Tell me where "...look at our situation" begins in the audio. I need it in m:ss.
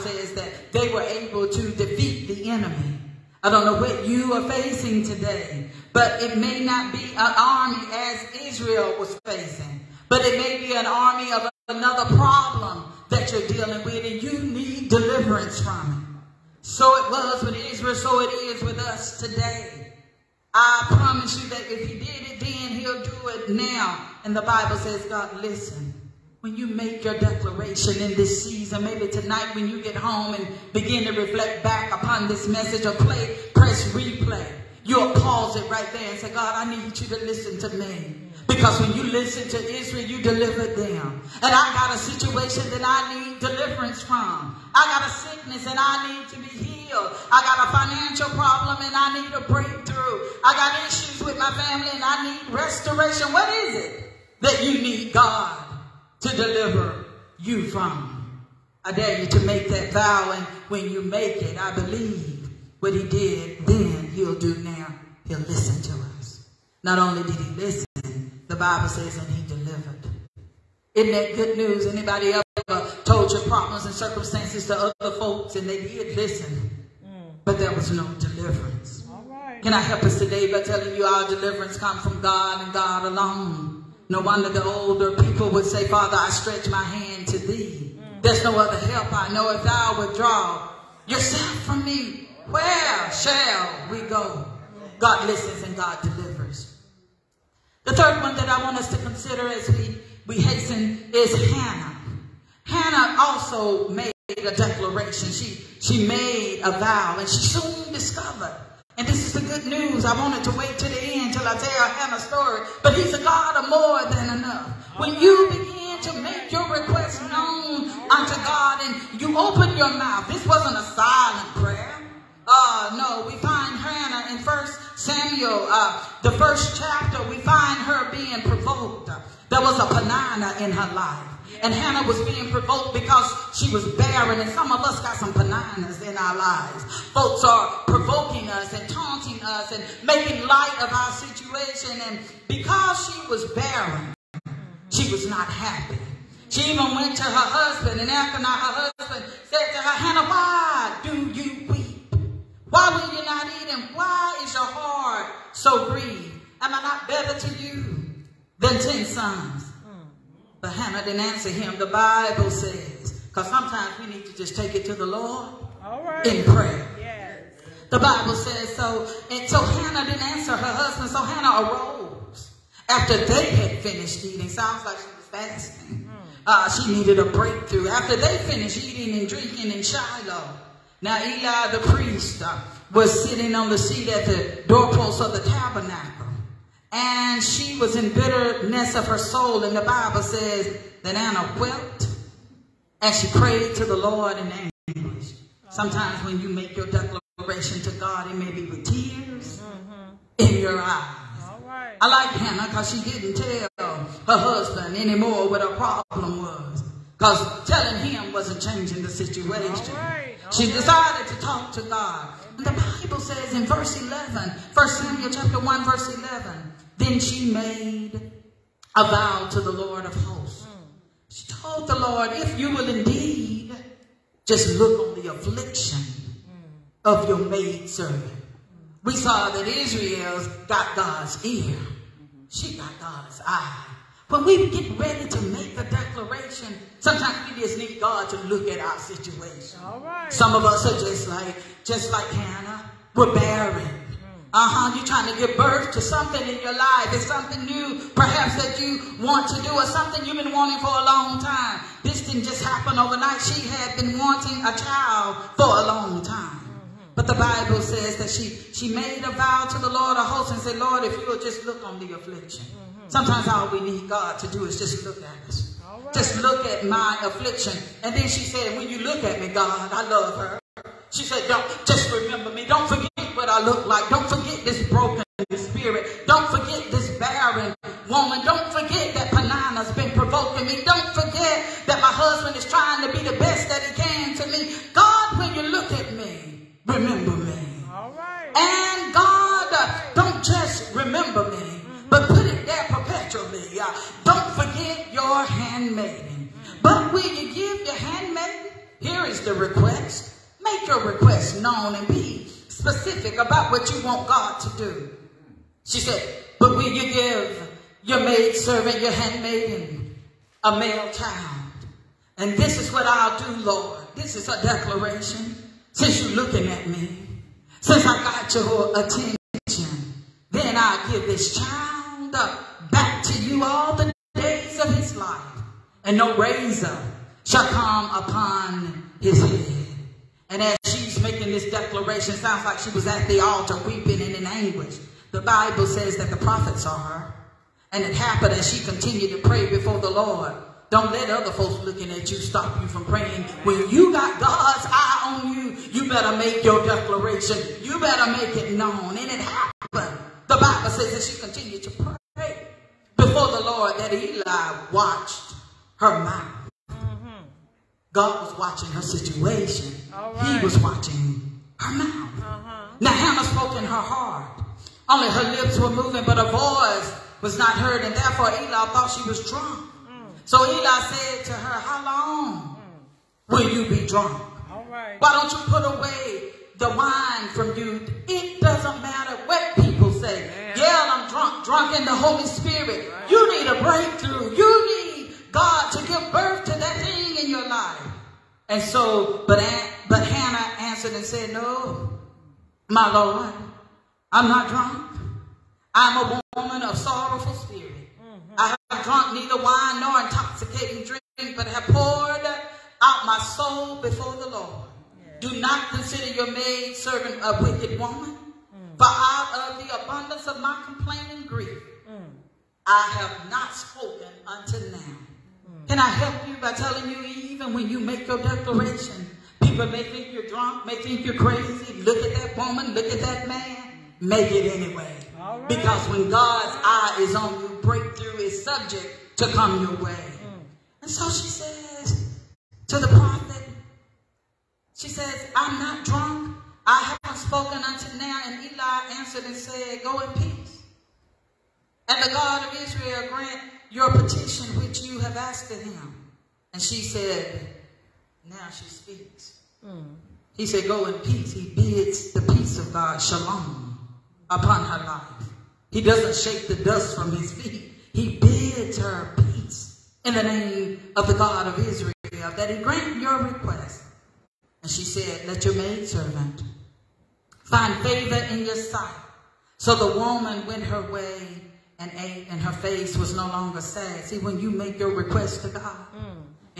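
3:58.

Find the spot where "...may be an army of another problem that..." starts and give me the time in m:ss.
0:10.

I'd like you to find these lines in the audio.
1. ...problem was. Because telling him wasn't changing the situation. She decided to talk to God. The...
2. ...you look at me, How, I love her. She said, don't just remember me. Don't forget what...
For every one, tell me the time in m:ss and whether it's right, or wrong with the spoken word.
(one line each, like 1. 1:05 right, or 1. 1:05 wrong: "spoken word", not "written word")
1. 3:25 right
2. 4:28 wrong: "God", not "How".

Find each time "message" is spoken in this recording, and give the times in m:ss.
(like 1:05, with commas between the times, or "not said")
0:32.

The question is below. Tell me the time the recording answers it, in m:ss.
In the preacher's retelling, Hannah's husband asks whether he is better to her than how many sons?
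2:38.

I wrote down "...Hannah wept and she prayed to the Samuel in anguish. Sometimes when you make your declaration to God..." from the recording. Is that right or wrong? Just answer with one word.
wrong.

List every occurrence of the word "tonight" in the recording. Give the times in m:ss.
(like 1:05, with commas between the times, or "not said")
0:29.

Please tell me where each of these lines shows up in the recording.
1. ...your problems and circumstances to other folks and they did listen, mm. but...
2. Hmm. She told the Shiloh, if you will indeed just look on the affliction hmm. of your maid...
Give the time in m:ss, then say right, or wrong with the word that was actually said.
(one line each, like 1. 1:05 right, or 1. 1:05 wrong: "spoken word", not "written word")
1. 1:13 right
2. 3:40 wrong: "Lord", not "Shiloh".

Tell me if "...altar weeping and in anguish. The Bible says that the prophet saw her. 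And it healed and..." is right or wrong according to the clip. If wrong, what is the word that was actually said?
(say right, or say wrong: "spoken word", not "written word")
wrong: "happened", not "healed".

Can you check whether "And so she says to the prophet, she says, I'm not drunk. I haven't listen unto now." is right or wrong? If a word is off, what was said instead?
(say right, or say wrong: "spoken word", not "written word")
wrong: "spoken", not "listen".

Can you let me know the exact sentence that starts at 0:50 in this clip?
I got issues with my family and I need restoration.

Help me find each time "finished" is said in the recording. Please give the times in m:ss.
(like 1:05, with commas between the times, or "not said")
2:53, 2:58.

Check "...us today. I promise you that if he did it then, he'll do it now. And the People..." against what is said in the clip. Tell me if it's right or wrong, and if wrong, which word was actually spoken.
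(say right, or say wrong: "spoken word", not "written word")
wrong: "Bible", not "People".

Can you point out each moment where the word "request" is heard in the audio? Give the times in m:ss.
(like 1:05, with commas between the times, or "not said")
1:56, 7:43, 7:55.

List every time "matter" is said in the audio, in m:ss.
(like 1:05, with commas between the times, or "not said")
6:19.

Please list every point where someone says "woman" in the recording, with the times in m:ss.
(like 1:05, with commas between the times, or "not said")
4:38, 6:36, 6:47, 7:02, 7:50.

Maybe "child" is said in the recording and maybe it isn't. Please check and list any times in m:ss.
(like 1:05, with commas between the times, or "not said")
4:14, 5:11, 5:21.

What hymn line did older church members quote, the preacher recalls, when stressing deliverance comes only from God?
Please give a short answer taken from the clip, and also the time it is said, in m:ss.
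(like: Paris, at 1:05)
Father, I stretch my hand to thee, at 1:25.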